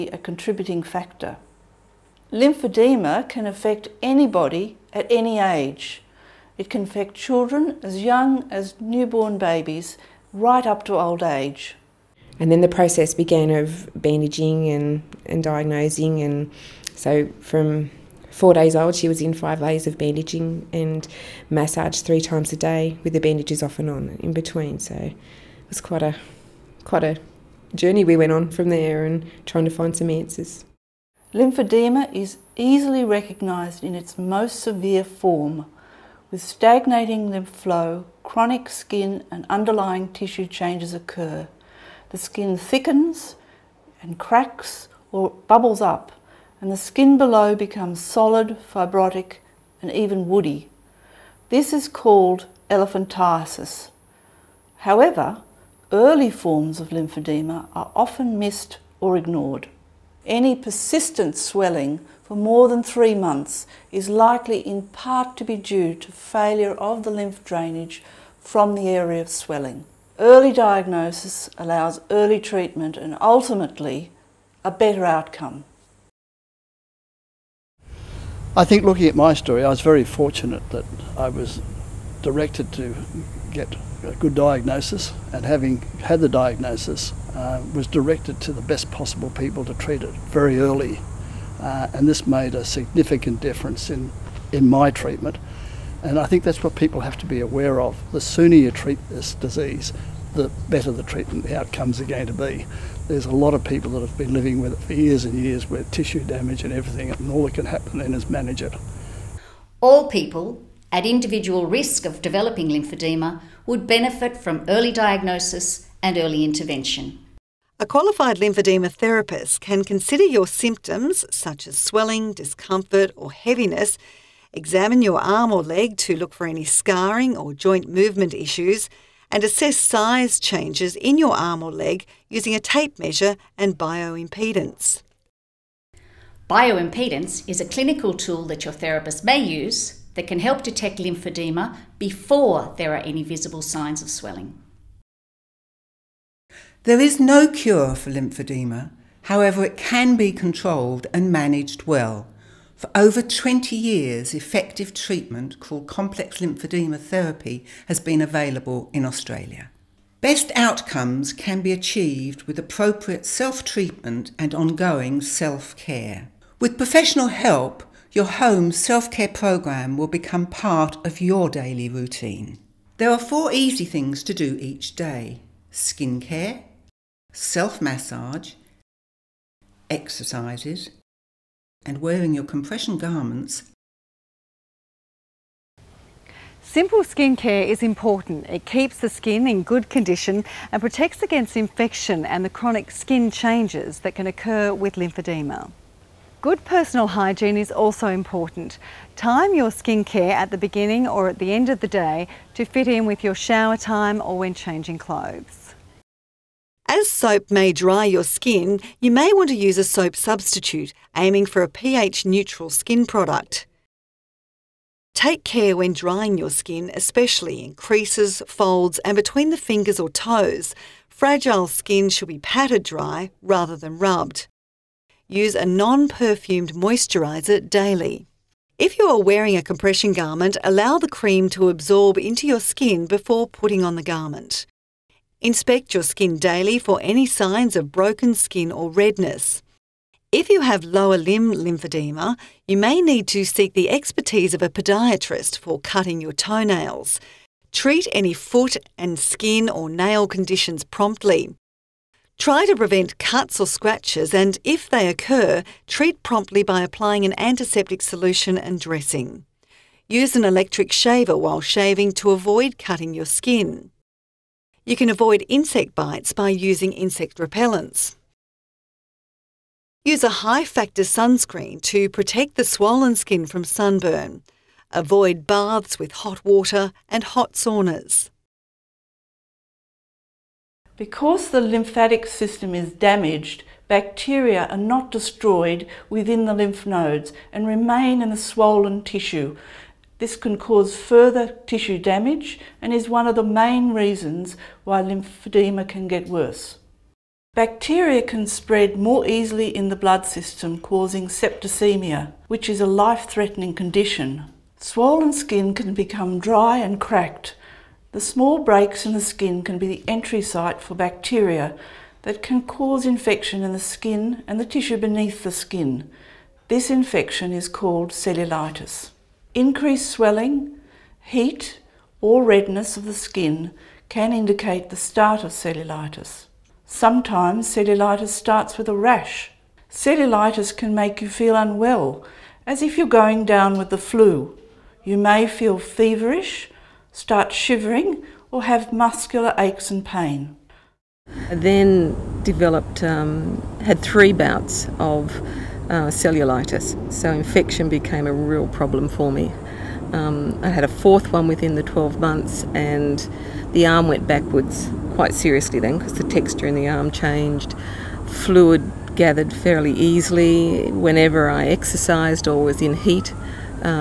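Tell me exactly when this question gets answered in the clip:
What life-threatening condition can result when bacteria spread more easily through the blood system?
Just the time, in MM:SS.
05:01.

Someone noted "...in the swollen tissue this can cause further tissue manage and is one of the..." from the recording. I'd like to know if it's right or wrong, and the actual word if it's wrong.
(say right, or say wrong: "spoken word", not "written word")
wrong: "damage", not "manage".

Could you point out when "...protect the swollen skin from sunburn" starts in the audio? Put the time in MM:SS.
04:32.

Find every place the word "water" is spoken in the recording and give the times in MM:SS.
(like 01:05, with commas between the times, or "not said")
04:36.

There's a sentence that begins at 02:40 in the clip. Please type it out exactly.
Best outcomes can be achieved with appropriate self treatment and ongoing self care.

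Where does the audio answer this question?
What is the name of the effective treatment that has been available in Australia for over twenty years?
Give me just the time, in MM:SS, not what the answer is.
02:35.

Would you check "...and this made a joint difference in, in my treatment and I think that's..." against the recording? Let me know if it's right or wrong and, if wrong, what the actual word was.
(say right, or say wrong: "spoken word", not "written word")
wrong: "significant", not "joint".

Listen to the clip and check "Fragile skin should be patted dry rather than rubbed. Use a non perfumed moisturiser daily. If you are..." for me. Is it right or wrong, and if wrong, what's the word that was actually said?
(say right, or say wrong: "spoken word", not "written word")
right.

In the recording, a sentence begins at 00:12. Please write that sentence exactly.
And then the process began of bandaging and, and diagnosing.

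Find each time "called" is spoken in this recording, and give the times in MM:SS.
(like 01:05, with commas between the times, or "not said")
00:51, 02:35, 05:17.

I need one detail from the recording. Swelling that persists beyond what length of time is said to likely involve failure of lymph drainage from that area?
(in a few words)
3 months.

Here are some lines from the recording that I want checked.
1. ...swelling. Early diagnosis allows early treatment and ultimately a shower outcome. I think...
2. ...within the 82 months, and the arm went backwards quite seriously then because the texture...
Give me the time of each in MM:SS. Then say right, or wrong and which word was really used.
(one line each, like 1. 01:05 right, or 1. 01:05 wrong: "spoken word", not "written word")
1. 01:09 wrong: "better", not "shower"
2. 05:51 wrong: "12", not "82".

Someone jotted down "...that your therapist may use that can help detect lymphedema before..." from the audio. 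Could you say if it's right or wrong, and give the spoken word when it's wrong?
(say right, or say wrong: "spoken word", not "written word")
right.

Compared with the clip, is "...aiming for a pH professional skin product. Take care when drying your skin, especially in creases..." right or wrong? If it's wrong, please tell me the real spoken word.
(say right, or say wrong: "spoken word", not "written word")
wrong: "neutral", not "professional".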